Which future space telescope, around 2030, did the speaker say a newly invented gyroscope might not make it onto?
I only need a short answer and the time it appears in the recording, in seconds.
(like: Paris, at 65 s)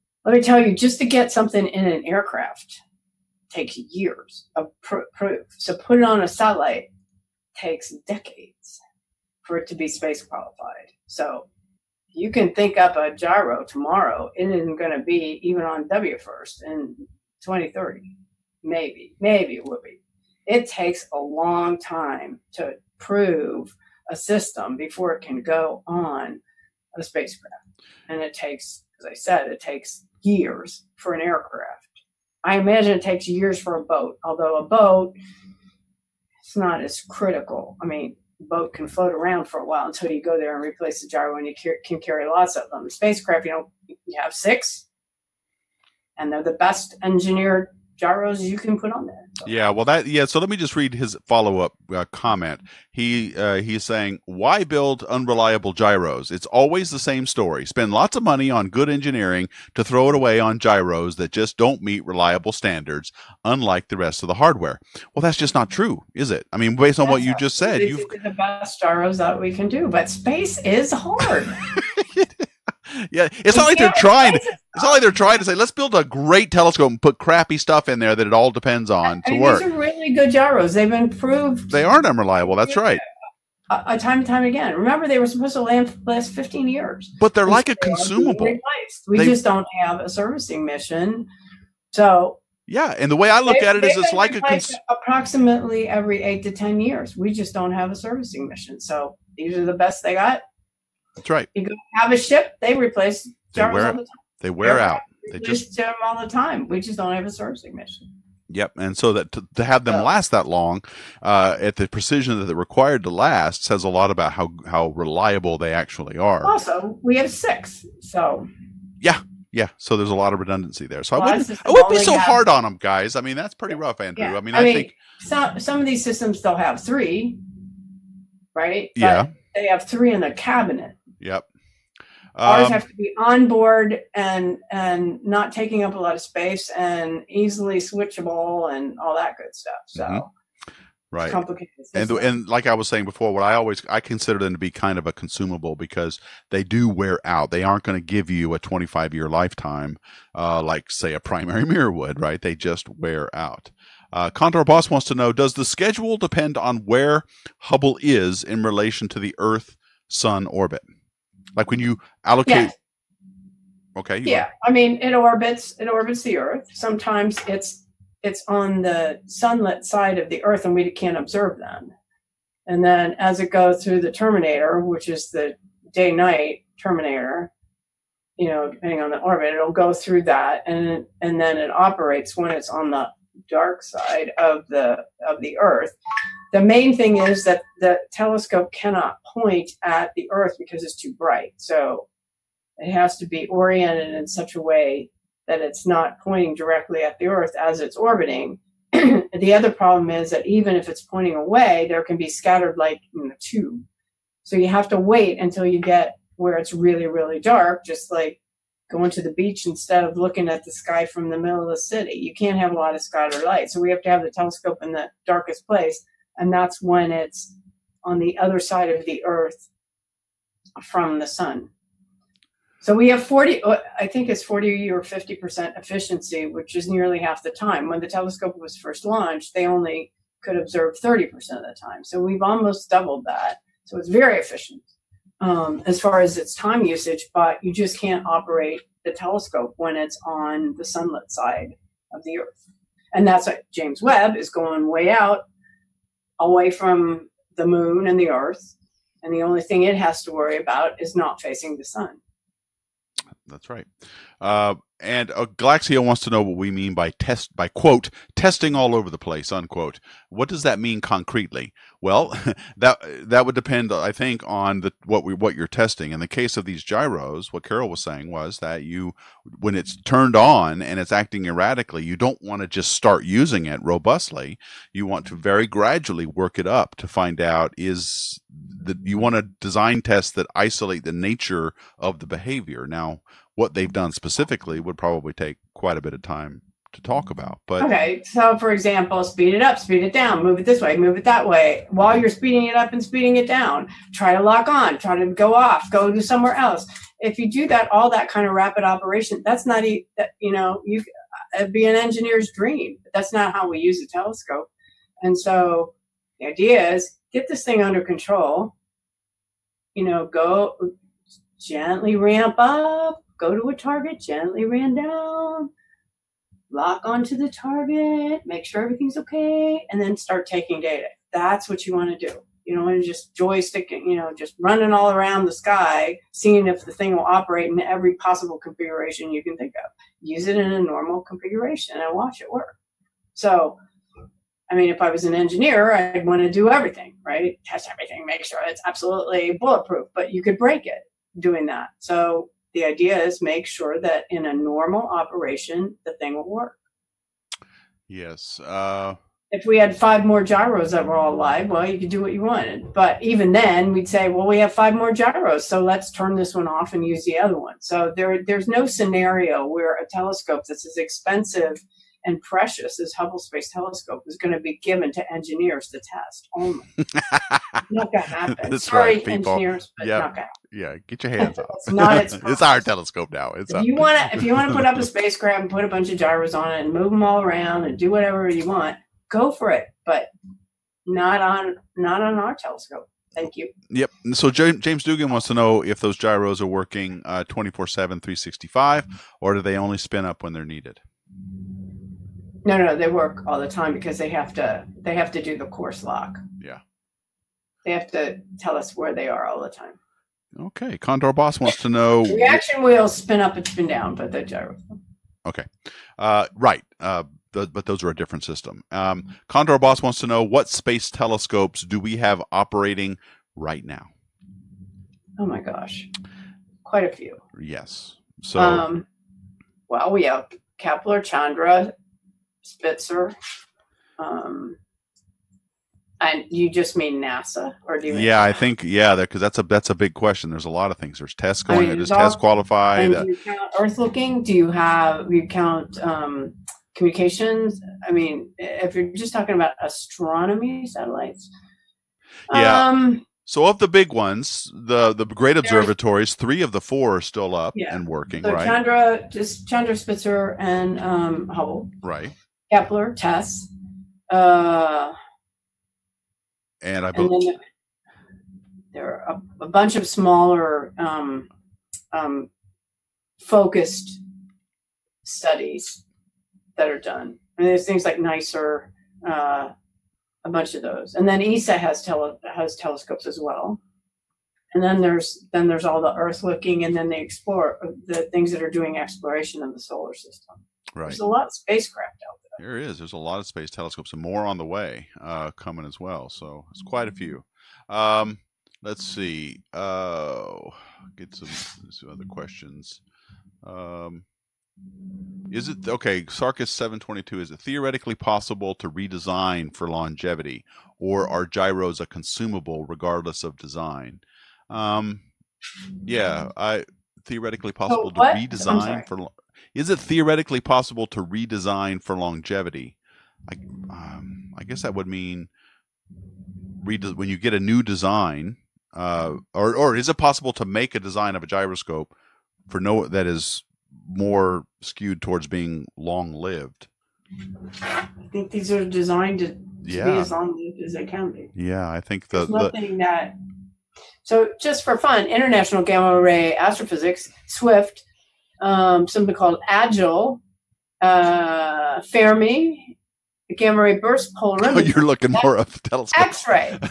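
WFIRST, at 15 s.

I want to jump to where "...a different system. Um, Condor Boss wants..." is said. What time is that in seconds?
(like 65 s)
408 s.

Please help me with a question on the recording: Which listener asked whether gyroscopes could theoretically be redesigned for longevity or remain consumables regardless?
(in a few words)
Sarkis 722.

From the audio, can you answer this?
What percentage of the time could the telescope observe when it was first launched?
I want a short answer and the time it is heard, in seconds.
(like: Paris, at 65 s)
30%, at 230 s.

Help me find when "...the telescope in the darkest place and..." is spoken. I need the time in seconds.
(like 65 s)
214 s.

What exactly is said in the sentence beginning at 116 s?
Also, we have six, so yeah, yeah.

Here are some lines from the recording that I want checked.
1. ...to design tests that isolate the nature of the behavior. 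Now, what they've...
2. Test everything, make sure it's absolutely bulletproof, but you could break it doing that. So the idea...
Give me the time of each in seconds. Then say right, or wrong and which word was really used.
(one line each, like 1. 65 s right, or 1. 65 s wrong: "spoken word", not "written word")
1. 279 s right
2. 337 s right.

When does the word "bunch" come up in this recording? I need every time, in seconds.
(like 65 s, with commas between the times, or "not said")
375 s, 459 s, 470 s.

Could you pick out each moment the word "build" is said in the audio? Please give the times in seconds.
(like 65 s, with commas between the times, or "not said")
54 s, 75 s.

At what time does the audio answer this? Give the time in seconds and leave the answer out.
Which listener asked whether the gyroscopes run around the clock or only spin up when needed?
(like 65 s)
384 s.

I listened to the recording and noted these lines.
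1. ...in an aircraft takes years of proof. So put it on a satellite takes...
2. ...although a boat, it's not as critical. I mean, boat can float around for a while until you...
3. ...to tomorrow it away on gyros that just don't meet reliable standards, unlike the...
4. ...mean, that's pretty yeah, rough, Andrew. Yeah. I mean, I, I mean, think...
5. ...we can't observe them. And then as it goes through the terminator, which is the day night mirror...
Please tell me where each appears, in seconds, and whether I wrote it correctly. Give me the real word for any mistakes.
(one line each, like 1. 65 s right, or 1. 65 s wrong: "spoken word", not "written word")
1. 1 s right
2. 34 s right
3. 59 s wrong: "throw", not "tomorrow"
4. 123 s right
5. 170 s wrong: "terminator", not "mirror".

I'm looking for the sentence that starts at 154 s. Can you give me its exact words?
Uh, Condor Boss wants to know: Does the schedule depend on where Hubble is in relation to the Earth Sun orbit?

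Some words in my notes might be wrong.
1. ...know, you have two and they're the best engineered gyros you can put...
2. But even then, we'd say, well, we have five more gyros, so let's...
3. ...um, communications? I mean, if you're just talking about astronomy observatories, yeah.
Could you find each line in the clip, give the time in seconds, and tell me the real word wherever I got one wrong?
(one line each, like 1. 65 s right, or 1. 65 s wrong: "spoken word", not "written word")
1. 43 s wrong: "six", not "two"
2. 352 s right
3. 436 s wrong: "satellites", not "observatories".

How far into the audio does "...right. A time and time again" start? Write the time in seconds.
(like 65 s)
82 s.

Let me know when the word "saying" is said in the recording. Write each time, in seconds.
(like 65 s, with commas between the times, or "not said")
53 s, 142 s, 268 s.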